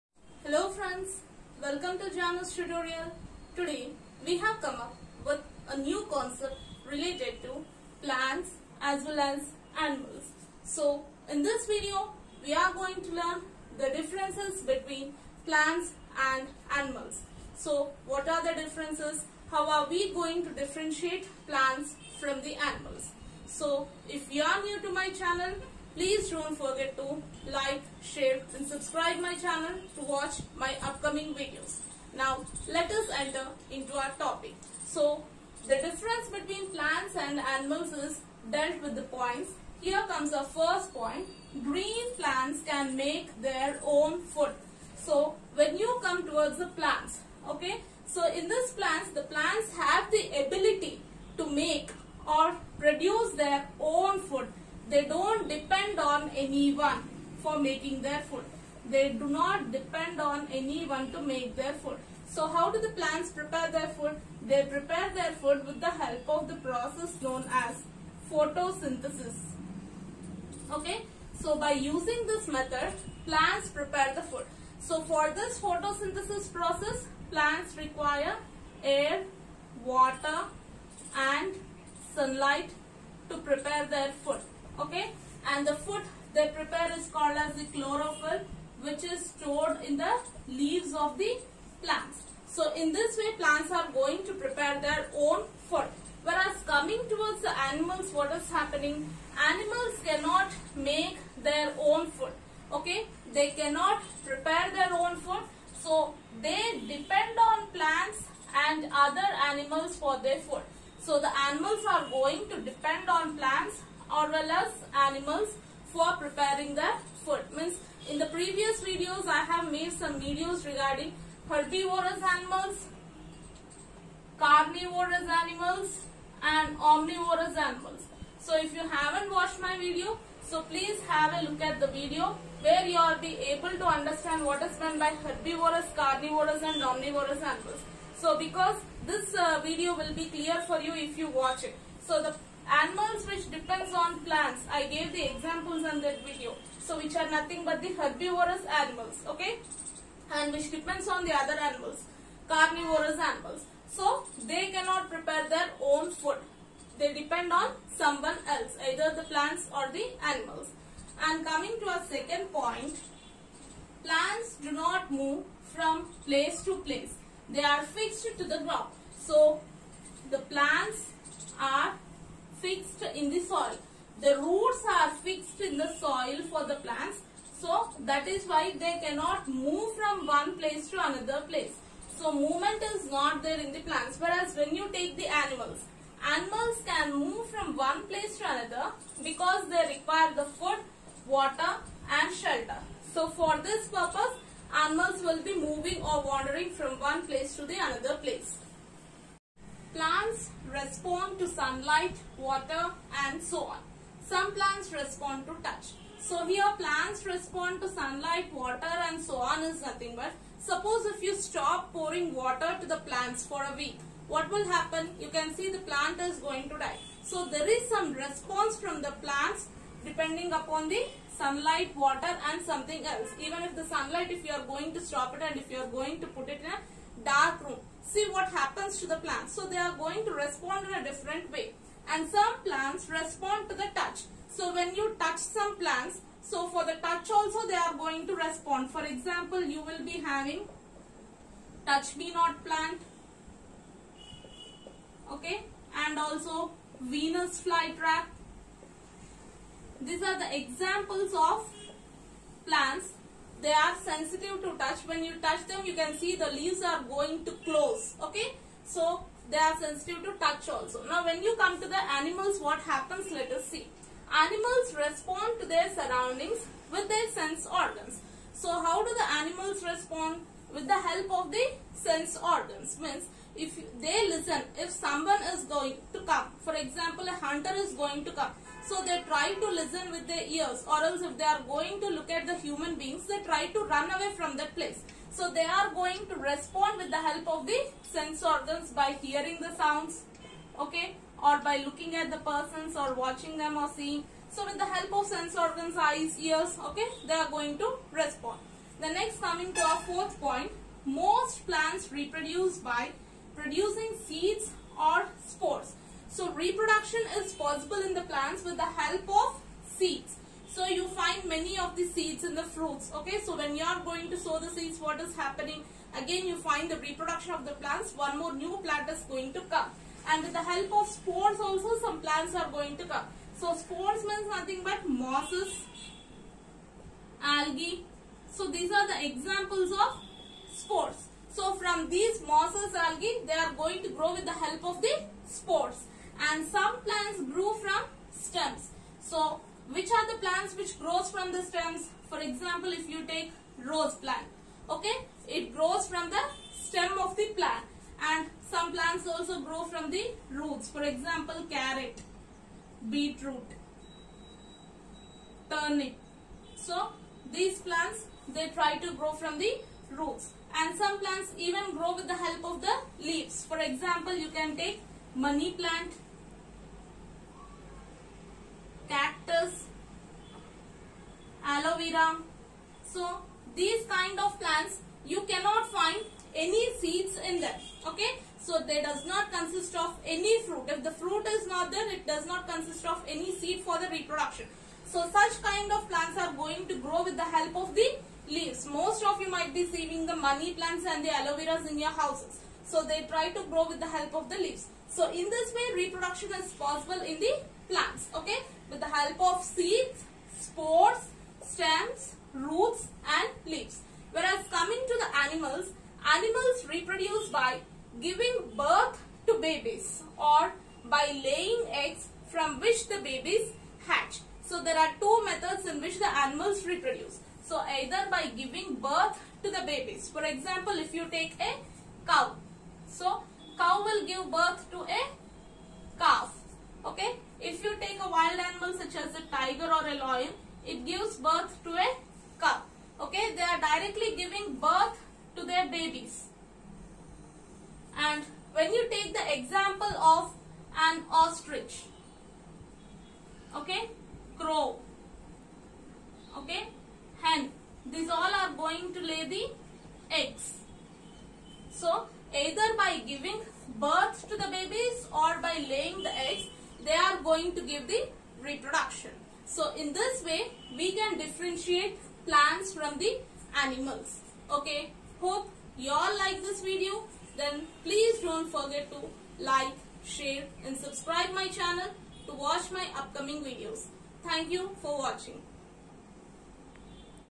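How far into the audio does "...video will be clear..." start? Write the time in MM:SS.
02:19.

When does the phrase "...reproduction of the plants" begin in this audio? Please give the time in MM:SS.
05:16.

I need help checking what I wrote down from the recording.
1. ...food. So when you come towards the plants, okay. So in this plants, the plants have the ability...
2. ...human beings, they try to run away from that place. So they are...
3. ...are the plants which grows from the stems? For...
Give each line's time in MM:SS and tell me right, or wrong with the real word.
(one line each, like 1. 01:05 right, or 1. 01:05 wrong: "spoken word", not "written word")
1. 00:44 right
2. 04:42 right
3. 05:40 right.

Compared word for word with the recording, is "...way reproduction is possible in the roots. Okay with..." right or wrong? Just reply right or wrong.
wrong.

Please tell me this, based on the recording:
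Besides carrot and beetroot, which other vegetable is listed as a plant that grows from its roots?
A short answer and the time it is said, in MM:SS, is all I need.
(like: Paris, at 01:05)
Turnip, at 05:55.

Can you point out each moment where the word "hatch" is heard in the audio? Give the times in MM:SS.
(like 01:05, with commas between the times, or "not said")
06:54.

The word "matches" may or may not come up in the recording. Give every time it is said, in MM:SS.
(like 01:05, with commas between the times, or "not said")
not said.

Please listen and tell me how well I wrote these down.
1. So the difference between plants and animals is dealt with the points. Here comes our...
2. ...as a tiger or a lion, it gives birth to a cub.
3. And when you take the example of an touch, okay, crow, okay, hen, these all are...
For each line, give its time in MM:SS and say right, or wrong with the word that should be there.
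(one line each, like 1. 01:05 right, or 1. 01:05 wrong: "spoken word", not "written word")
1. 00:34 right
2. 07:09 right
3. 07:18 wrong: "ostrich", not "touch".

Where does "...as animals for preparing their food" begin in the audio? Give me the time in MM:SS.
01:54.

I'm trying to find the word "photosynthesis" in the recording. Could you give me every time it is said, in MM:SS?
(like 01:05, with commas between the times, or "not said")
01:08, 01:15.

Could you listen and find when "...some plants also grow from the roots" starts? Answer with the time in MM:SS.
05:48.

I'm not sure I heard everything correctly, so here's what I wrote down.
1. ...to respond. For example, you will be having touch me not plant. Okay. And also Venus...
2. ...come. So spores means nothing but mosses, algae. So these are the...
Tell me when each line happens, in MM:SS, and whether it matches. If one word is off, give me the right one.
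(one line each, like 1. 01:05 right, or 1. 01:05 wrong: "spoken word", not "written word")
1. 03:58 right
2. 05:23 right.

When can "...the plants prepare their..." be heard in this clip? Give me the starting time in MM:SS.
01:02.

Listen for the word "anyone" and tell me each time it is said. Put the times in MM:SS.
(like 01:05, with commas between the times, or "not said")
00:56, 01:00.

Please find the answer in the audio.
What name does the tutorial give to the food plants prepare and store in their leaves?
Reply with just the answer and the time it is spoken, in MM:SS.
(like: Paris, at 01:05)
chlorophyll, at 01:27.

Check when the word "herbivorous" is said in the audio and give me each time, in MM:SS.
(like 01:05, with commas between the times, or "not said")
02:01, 02:15, 02:27.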